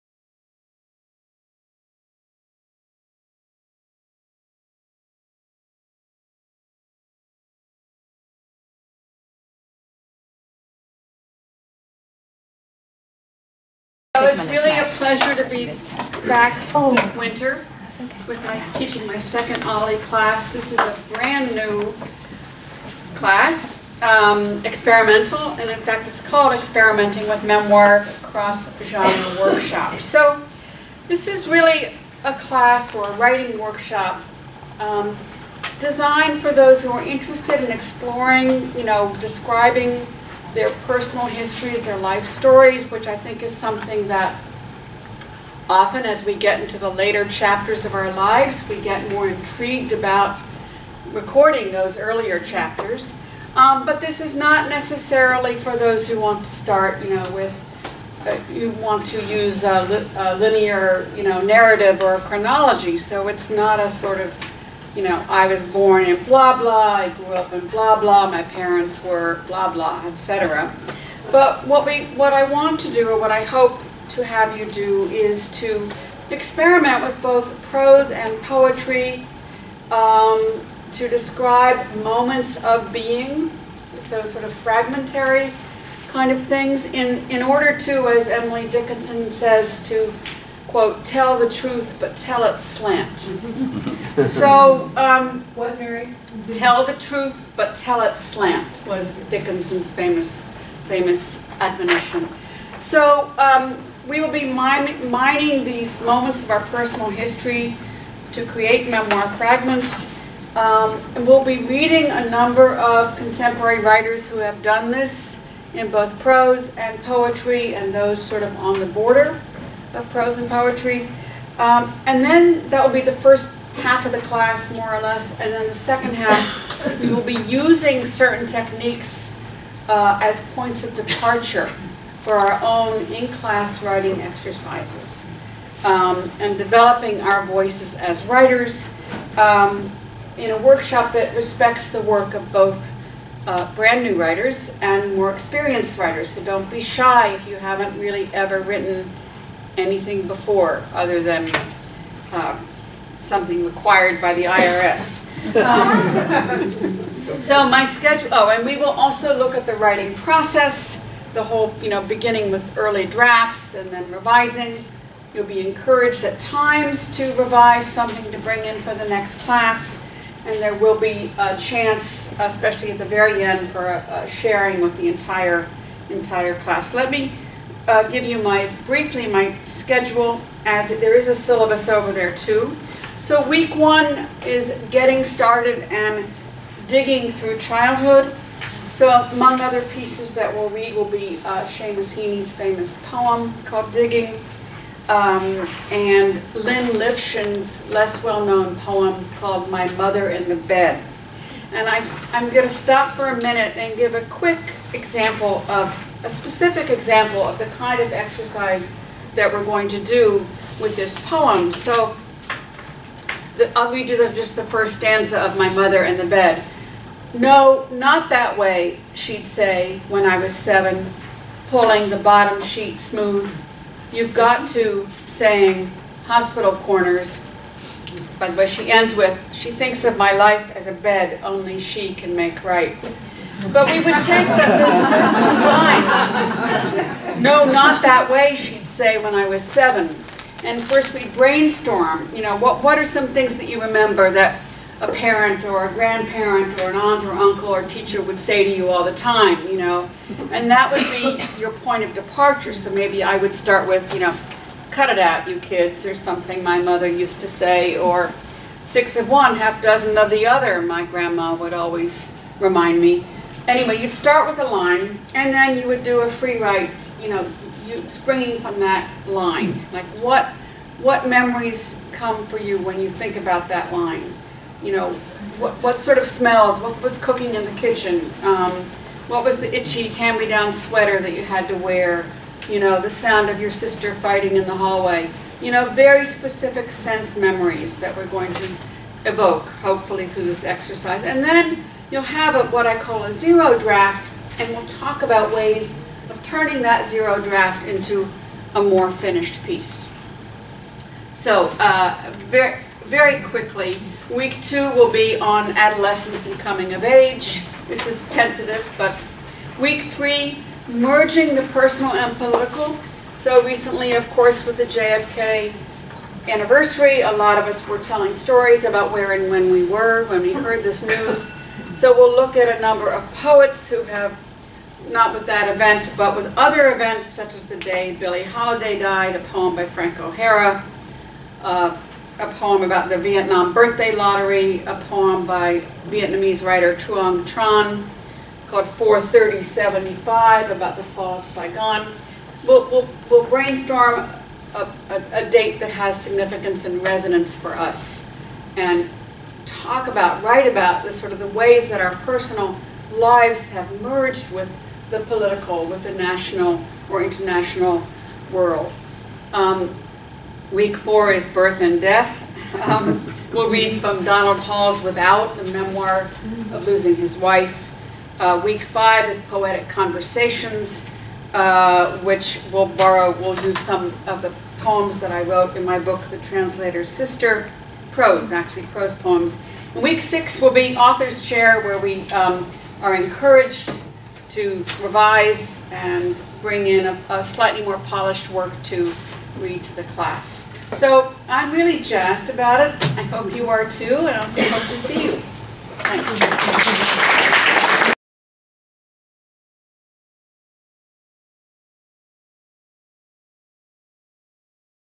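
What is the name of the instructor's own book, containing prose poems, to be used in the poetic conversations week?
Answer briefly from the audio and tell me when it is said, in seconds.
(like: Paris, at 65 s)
The Translator's Sister, at 376 s.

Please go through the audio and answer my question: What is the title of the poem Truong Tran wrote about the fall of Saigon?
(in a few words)
43075.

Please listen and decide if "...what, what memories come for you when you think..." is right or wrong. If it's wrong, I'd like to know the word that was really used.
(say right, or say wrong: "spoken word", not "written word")
right.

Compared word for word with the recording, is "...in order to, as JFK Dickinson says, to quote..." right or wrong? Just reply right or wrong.
wrong.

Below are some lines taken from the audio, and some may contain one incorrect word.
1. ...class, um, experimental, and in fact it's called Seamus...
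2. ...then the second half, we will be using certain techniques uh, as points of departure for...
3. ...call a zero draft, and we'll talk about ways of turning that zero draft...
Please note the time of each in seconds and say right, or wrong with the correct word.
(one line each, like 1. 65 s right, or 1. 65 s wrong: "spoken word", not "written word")
1. 23 s wrong: "Experimenting", not "Seamus"
2. 125 s right
3. 292 s right.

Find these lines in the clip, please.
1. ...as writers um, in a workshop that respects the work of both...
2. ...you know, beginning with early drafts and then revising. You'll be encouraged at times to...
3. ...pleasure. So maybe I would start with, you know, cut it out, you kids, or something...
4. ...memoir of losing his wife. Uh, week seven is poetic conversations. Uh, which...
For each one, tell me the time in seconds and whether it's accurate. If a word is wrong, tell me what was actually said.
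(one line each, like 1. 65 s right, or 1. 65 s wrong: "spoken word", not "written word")
1. 137 s right
2. 161 s right
3. 252 s wrong: "departure", not "pleasure"
4. 365 s wrong: "five", not "seven".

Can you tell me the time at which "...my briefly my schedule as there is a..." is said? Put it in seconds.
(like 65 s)
178 s.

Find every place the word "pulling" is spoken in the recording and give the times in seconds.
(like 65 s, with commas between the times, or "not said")
221 s.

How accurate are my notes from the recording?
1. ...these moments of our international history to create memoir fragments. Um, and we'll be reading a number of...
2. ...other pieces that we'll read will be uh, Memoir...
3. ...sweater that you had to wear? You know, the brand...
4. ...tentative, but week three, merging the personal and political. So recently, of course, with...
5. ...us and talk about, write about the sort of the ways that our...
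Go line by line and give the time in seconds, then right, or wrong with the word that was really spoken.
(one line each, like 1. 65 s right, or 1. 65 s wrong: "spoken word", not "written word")
1. 105 s wrong: "personal", not "international"
2. 189 s wrong: "Seamus", not "Memoir"
3. 280 s wrong: "sound", not "brand"
4. 308 s right
5. 347 s right.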